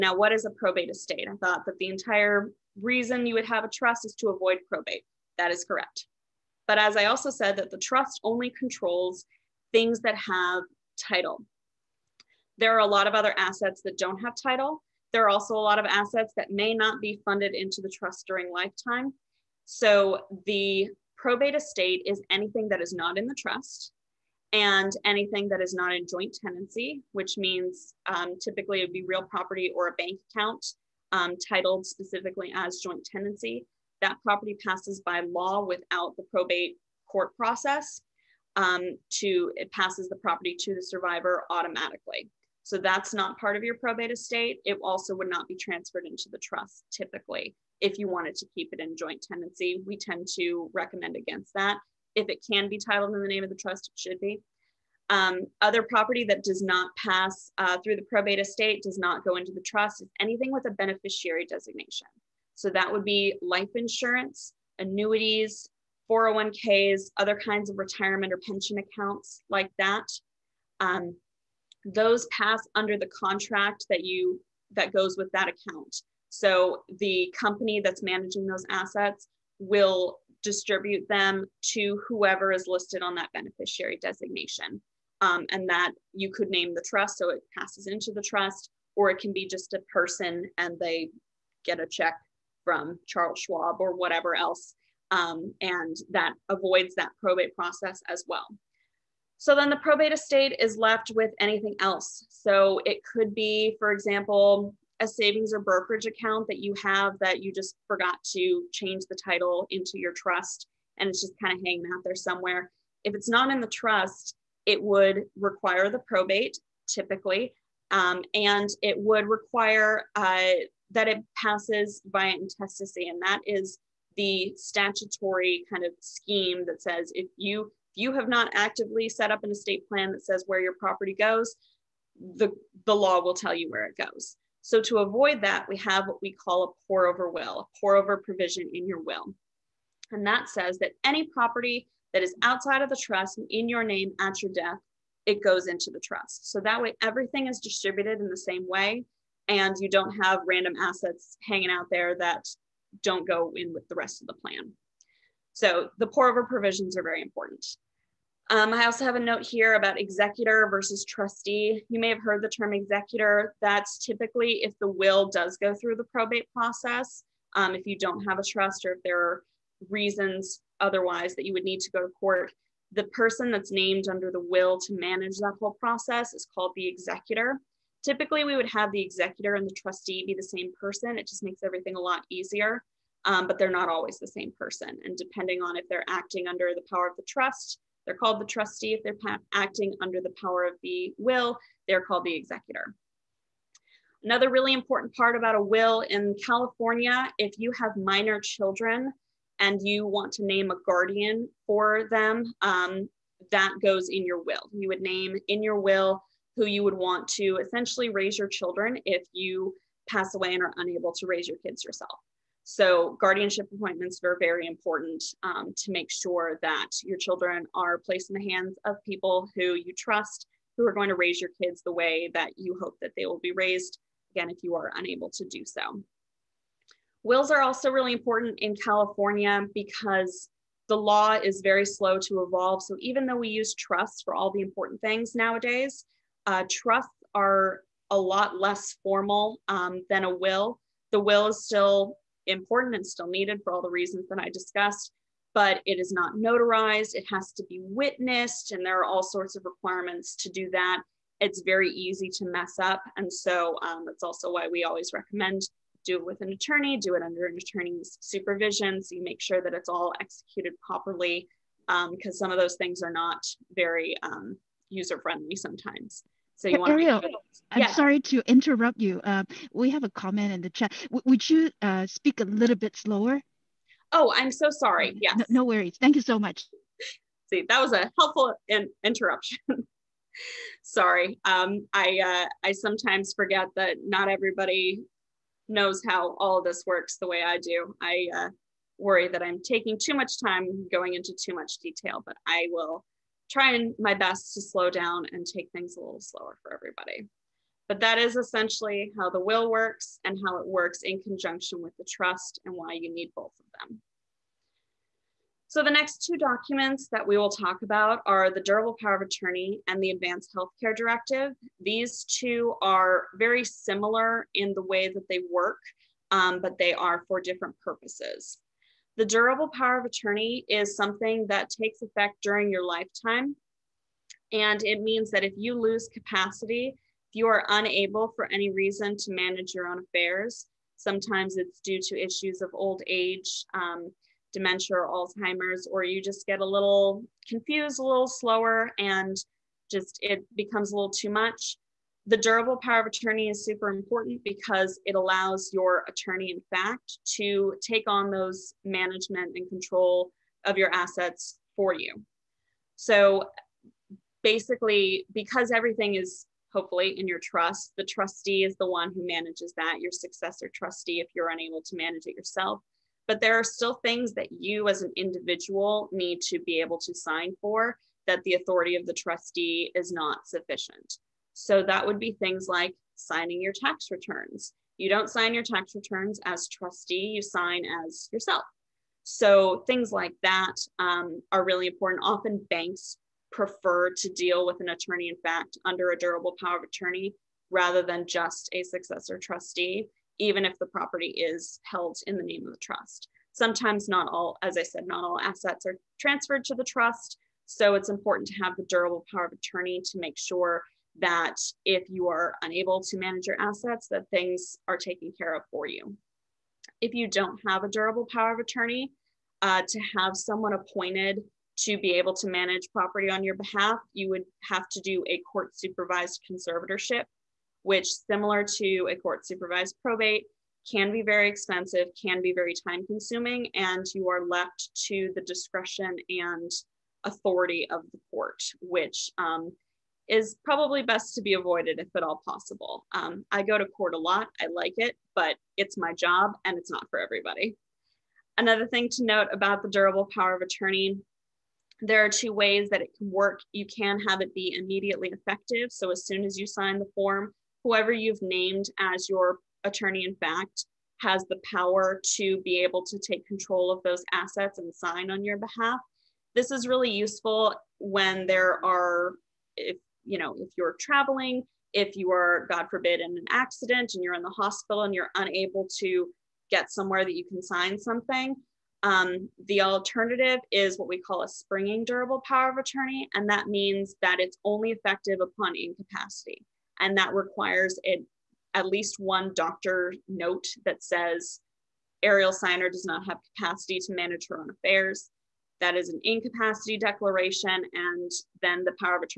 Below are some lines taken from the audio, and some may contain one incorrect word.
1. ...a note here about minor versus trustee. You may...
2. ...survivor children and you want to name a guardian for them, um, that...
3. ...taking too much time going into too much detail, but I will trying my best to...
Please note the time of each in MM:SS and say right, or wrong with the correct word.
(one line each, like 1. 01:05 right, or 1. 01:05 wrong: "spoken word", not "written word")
1. 02:39 wrong: "executor", not "minor"
2. 03:17 wrong: "minor", not "survivor"
3. 04:49 right.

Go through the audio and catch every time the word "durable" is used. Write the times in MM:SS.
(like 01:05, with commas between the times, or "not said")
05:08, 05:19, 05:42, 06:26, 06:38, 06:47, 07:19, 07:52.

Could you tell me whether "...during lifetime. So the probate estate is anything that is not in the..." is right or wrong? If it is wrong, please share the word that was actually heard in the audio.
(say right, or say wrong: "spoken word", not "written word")
right.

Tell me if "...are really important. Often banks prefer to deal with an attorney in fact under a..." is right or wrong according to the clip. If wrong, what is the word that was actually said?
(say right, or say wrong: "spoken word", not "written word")
right.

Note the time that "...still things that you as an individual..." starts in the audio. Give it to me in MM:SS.
06:03.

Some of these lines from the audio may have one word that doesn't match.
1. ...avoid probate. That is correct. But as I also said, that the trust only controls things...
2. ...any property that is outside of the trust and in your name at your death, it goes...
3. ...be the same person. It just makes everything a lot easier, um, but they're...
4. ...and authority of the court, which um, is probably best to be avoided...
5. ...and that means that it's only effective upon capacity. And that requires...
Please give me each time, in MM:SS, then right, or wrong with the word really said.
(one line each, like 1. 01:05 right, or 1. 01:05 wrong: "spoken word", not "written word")
1. 00:04 right
2. 02:21 right
3. 03:00 right
4. 07:06 right
5. 07:53 wrong: "incapacity", not "capacity".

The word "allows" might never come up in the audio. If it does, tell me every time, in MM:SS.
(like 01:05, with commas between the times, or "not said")
05:45.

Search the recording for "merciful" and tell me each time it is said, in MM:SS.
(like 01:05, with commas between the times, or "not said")
not said.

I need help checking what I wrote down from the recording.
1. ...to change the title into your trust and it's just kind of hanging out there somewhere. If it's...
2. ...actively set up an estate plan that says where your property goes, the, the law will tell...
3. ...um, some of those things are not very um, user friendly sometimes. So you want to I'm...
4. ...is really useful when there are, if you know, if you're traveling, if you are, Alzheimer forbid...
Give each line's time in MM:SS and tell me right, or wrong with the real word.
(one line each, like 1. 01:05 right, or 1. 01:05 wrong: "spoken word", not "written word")
1. 01:48 right
2. 02:08 right
3. 04:22 right
4. 07:36 wrong: "God", not "Alzheimer".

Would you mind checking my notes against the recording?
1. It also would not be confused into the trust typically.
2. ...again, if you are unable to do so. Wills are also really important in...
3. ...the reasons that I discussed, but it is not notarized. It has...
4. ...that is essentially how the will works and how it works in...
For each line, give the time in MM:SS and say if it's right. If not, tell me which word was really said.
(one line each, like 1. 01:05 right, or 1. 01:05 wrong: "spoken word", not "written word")
1. 00:44 wrong: "transferred", not "confused"
2. 03:44 right
3. 04:03 right
4. 04:57 right.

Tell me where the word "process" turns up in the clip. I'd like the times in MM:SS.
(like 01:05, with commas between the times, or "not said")
00:37, 01:37, 02:46, 02:55.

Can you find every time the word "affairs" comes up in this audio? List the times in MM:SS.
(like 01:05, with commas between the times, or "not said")
05:29, 08:04.